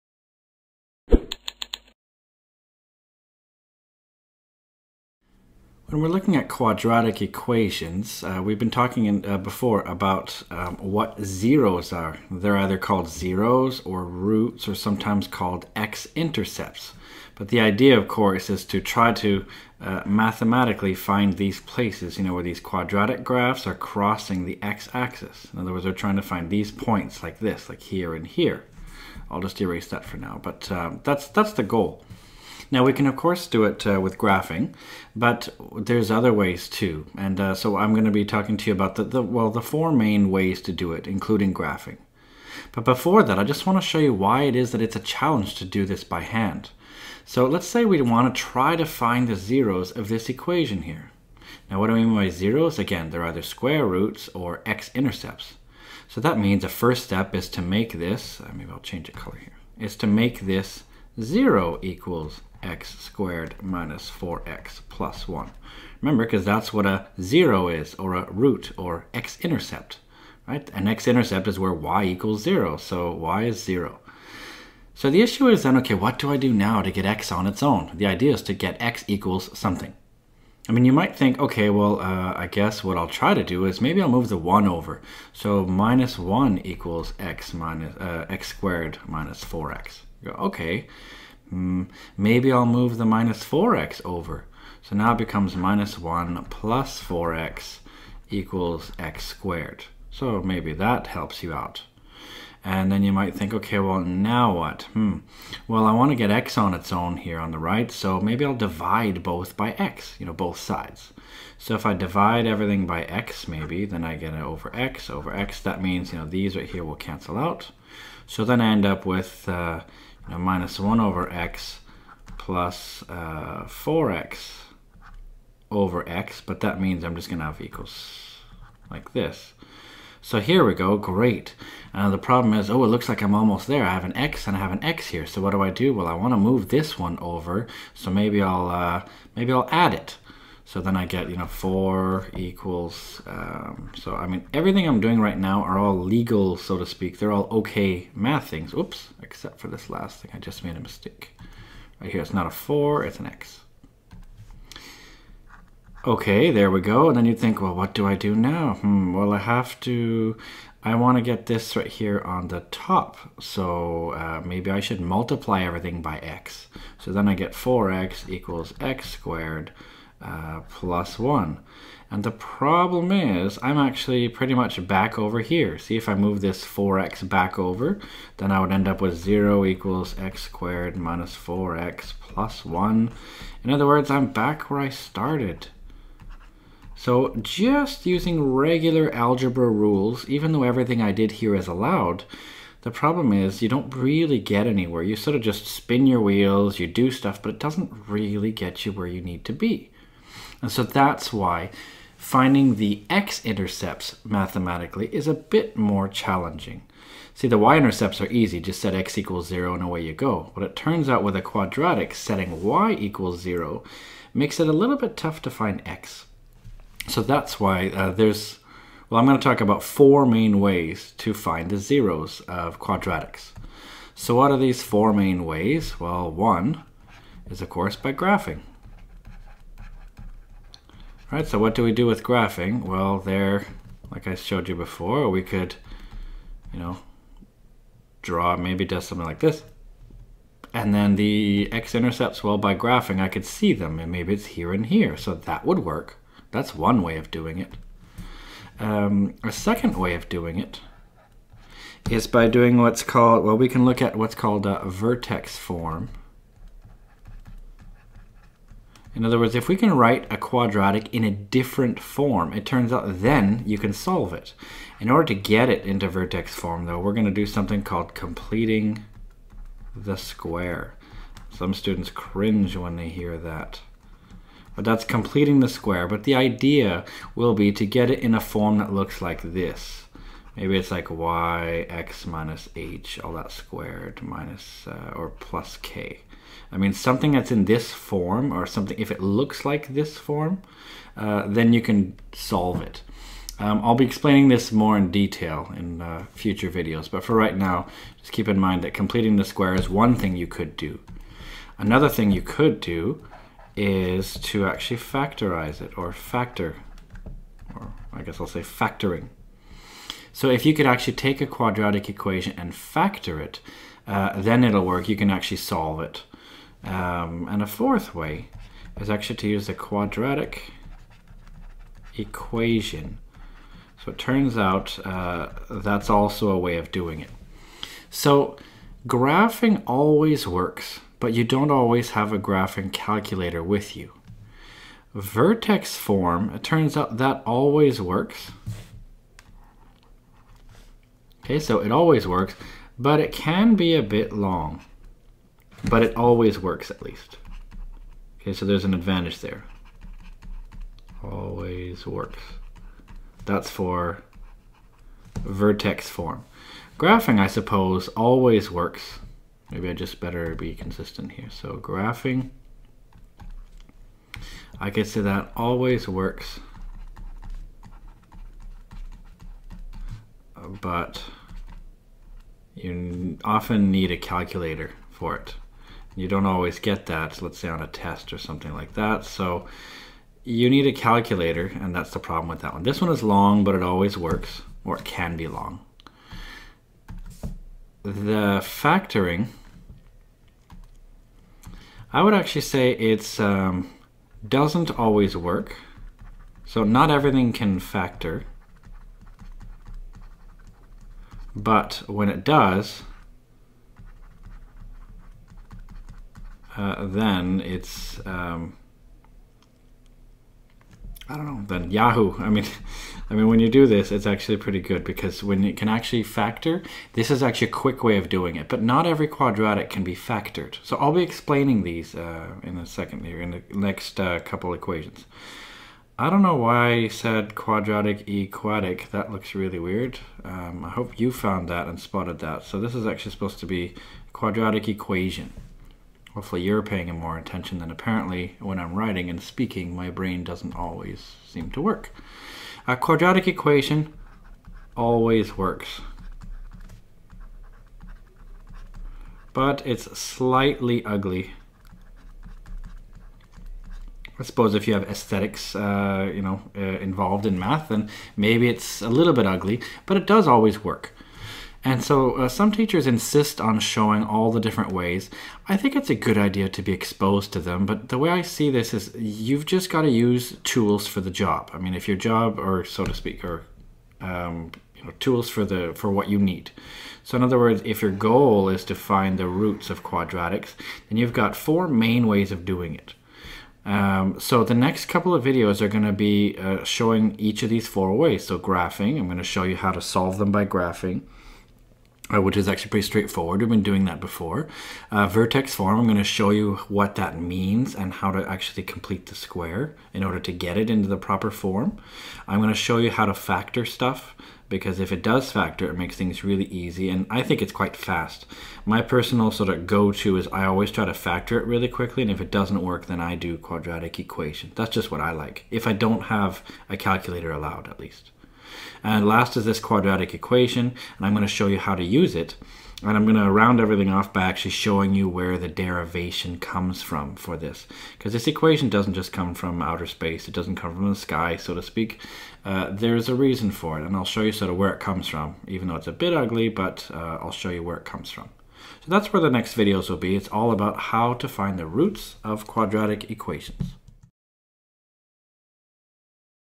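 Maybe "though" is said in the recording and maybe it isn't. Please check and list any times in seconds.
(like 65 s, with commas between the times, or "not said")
190 s, 266 s, 535 s.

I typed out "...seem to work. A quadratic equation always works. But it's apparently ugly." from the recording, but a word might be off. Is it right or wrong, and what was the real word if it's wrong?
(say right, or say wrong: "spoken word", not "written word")
wrong: "slightly", not "apparently".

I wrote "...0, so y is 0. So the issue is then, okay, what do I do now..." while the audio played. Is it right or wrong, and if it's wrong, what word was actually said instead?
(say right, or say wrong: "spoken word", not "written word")
right.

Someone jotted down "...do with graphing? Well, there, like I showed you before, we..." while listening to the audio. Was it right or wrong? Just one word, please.
right.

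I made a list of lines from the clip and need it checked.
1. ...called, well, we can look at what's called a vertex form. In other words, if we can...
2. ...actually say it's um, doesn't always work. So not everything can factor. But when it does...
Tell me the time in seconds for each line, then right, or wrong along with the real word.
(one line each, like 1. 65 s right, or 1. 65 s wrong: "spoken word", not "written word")
1. 253 s right
2. 392 s right.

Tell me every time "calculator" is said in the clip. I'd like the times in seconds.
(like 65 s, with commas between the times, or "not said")
332 s, 374 s, 380 s, 516 s.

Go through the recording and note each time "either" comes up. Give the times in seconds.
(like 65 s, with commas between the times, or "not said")
12 s, 53 s.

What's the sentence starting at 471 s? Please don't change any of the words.
I mean, if your job, or so to speak, or um, you know, tools for the for what you need.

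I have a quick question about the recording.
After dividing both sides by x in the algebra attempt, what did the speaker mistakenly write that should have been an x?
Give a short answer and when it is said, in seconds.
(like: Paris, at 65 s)
4, at 152 s.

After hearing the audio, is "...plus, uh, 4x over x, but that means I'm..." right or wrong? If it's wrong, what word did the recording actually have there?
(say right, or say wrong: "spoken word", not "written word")
right.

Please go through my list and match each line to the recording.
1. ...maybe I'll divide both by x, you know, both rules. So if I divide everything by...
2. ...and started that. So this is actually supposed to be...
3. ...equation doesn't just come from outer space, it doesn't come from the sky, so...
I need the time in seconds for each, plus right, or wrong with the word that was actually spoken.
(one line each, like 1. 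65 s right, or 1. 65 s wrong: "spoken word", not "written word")
1. 108 s wrong: "sides", not "rules"
2. 431 s wrong: "spotted", not "started"
3. 528 s right.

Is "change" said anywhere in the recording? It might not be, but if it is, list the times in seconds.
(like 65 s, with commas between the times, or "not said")
58 s.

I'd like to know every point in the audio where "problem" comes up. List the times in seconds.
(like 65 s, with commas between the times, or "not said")
132 s, 172 s, 192 s, 382 s.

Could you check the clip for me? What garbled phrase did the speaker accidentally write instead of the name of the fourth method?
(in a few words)
quadratic equatic.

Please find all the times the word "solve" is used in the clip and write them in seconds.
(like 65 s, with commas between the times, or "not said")
263 s, 292 s, 315 s, 490 s.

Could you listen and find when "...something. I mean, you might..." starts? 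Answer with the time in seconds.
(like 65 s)
79 s.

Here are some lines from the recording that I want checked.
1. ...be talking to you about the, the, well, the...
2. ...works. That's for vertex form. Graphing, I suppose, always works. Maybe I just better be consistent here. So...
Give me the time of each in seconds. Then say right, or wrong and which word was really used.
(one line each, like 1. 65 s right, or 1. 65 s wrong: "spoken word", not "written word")
1. 38 s right
2. 352 s right.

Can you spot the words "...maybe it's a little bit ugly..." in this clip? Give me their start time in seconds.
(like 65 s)
458 s.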